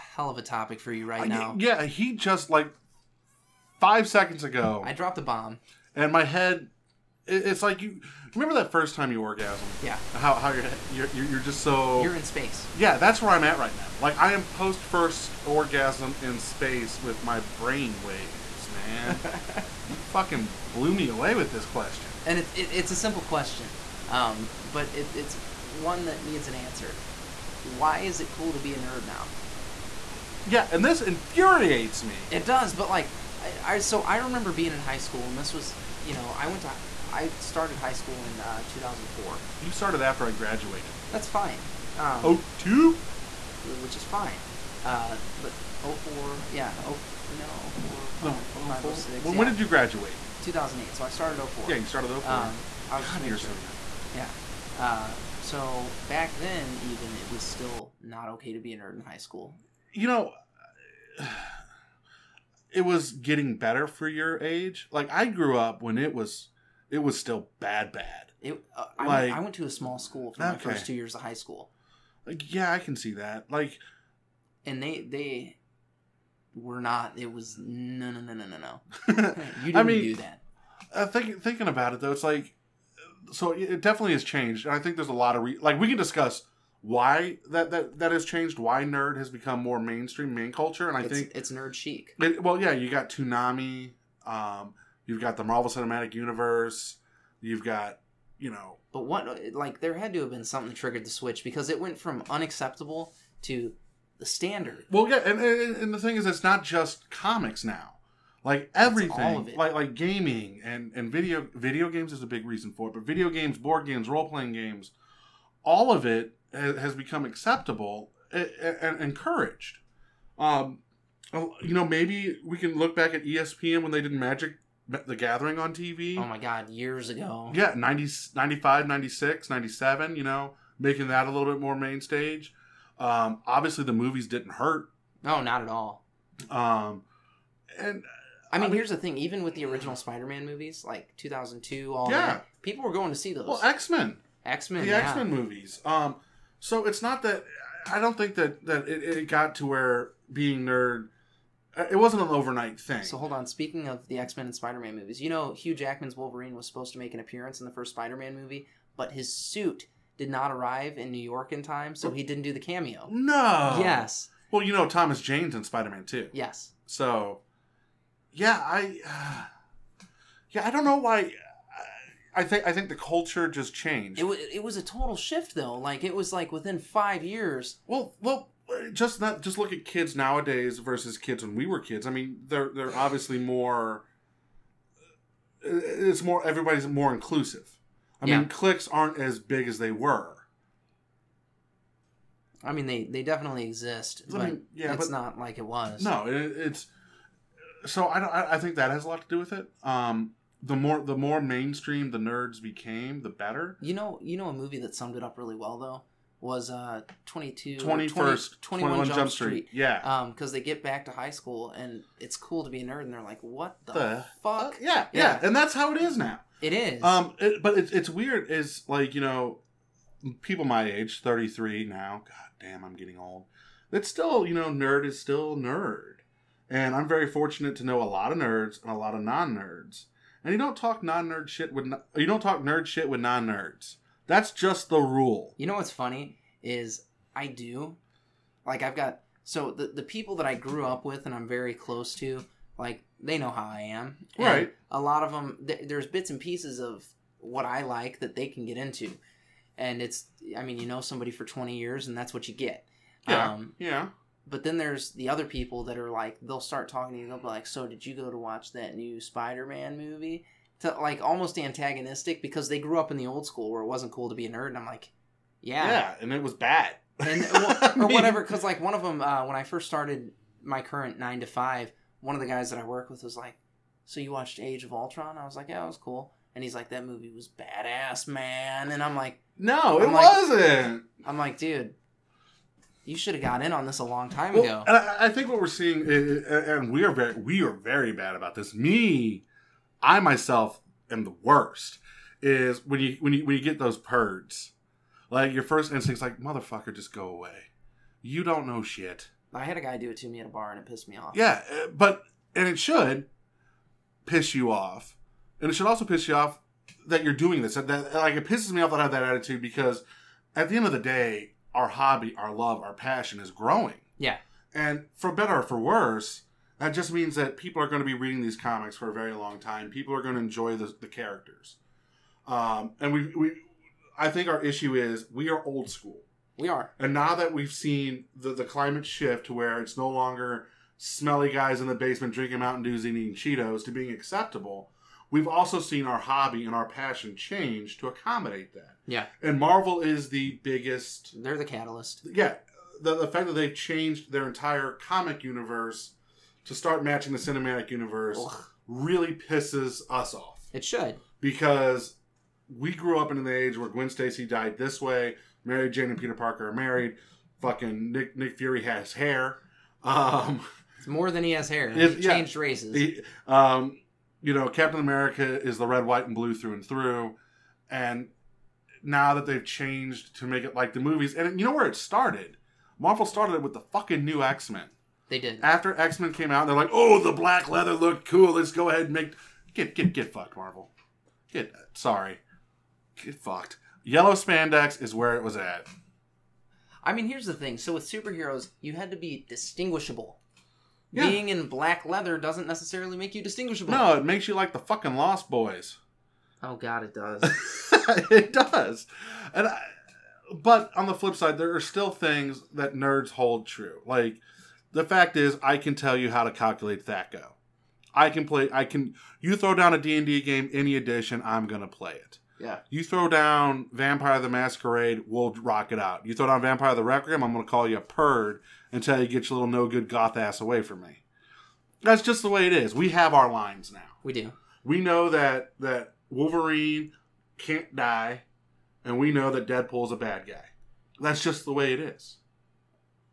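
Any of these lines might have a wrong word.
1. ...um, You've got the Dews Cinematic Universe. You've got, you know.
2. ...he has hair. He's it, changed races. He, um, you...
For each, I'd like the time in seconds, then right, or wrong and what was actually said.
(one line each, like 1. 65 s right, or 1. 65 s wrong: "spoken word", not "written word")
1. 94 s wrong: "Marvel", not "Dews"
2. 361 s right.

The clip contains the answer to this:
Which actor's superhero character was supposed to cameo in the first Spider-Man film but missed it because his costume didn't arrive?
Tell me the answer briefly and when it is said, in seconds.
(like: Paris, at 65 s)
Hugh Jackman, at 155 s.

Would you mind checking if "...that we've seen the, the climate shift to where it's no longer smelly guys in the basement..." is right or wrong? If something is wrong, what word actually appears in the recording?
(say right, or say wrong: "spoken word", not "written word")
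right.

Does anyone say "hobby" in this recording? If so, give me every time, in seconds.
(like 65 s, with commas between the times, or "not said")
311 s, 336 s.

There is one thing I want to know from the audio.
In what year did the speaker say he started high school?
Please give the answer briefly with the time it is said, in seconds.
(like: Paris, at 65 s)
2004, at 38 s.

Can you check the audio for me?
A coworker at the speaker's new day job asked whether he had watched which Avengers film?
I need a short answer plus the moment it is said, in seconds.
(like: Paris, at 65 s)
Age of Ultron, at 274 s.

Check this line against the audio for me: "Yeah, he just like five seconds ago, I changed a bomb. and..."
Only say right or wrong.
wrong.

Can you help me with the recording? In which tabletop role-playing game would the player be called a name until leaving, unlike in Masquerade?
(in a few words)
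Vampire the Requiem.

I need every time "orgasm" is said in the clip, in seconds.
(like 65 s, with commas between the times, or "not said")
9 s, 15 s.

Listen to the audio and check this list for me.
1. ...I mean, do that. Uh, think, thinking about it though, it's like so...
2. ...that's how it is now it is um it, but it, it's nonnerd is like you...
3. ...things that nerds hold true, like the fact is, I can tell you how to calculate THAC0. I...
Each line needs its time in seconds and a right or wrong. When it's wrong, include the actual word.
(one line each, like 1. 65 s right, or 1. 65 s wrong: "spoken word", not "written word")
1. 79 s right
2. 215 s wrong: "weird", not "nonnerd"
3. 402 s right.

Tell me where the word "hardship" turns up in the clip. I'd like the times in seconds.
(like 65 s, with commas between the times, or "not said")
not said.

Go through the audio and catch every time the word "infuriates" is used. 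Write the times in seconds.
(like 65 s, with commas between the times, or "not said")
31 s.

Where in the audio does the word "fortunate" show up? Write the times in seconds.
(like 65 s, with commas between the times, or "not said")
227 s.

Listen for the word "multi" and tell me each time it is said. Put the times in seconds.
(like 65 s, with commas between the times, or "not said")
not said.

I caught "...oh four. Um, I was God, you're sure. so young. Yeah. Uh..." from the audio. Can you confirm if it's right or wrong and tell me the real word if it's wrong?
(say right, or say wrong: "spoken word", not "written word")
right.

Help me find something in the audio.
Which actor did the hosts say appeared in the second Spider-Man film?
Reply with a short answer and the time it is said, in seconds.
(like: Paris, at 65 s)
Thomas Jane, at 164 s.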